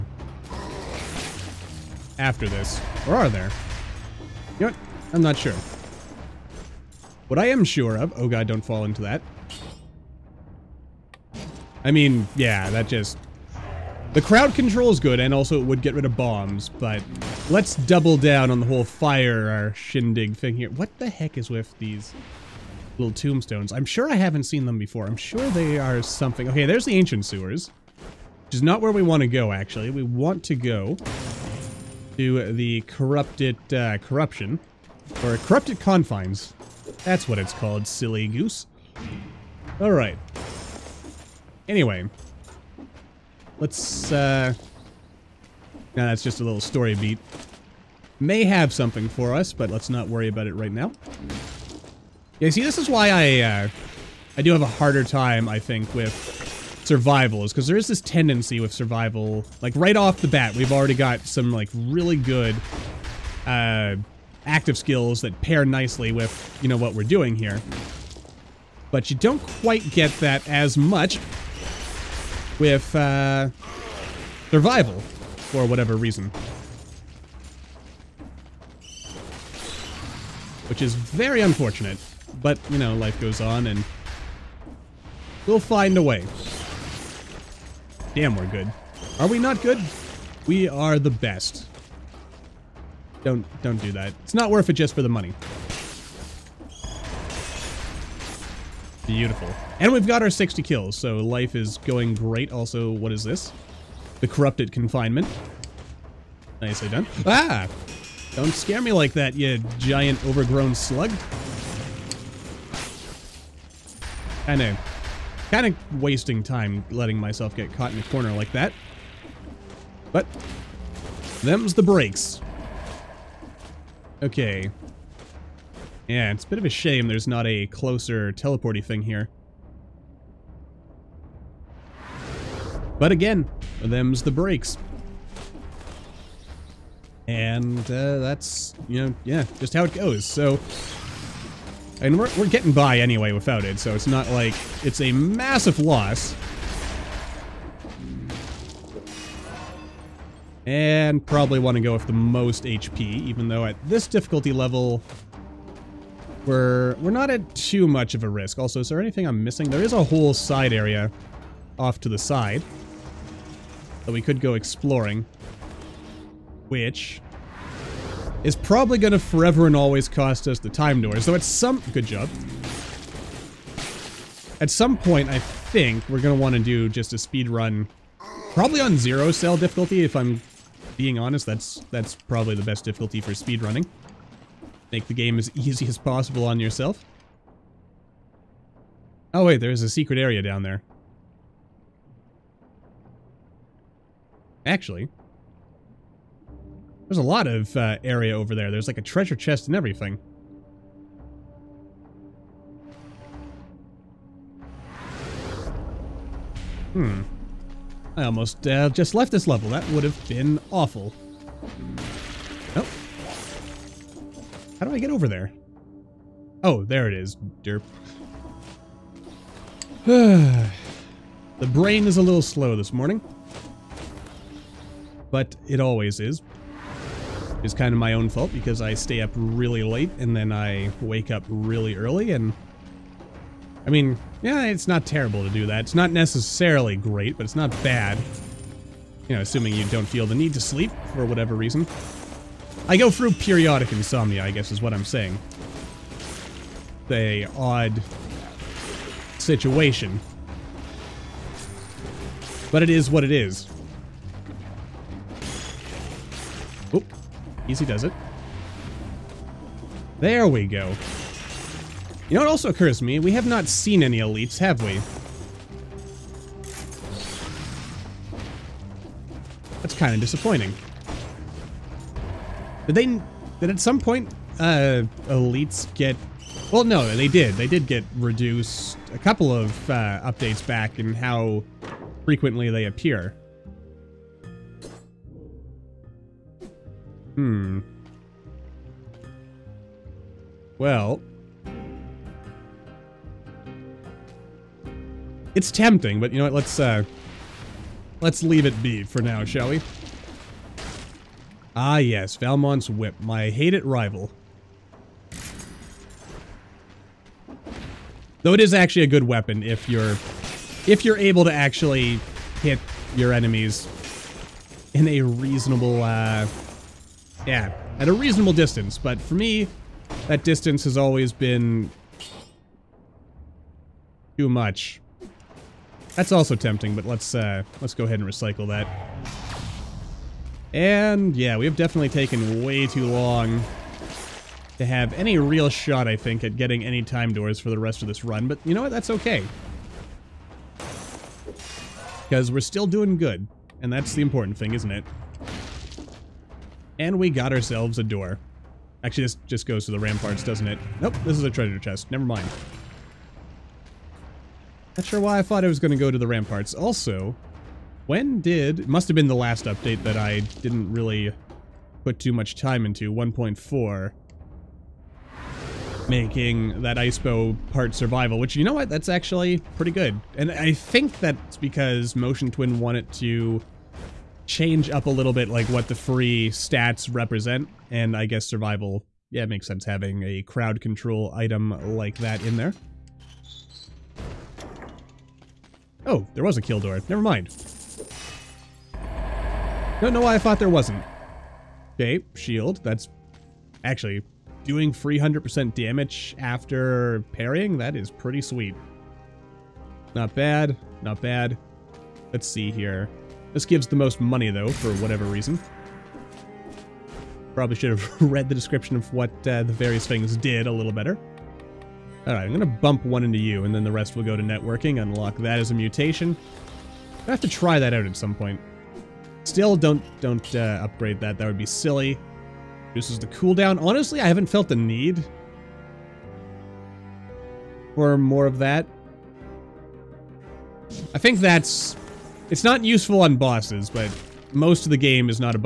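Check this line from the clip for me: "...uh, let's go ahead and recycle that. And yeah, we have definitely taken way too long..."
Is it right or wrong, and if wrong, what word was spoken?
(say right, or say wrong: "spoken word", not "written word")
right.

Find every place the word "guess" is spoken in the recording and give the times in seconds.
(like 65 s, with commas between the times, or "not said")
244 s, 378 s.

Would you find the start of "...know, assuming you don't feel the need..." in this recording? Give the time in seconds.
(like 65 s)
239 s.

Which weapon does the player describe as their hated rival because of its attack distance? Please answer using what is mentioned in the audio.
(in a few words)
Valmont's whip.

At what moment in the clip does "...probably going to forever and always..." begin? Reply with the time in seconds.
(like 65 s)
168 s.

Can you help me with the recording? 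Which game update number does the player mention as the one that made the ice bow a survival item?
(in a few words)
1.4.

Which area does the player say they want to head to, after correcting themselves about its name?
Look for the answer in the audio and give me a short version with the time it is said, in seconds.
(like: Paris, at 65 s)
Corrupted Confines, at 35 s.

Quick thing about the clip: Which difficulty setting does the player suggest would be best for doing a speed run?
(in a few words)
Zero cell.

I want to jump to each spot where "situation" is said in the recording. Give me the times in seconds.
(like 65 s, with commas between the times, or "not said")
249 s.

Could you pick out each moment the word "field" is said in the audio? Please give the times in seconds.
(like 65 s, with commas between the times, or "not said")
not said.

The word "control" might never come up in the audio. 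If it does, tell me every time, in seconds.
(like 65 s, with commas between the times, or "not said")
14 s, 380 s.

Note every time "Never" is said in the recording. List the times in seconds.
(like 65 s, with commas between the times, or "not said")
352 s, 387 s.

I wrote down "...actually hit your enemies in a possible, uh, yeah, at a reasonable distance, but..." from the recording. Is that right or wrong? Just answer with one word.
wrong.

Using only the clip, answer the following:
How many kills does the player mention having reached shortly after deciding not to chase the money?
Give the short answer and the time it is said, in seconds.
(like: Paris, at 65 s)
60, at 100 s.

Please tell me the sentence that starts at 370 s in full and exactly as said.
And I think that's because Motion Twin wanted to change up a little bit like what the free stats represent.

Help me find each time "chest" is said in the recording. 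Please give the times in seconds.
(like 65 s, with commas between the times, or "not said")
199 s, 351 s.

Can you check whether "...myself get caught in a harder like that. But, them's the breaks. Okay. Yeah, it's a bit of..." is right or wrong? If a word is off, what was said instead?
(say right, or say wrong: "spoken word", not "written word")
wrong: "corner", not "harder".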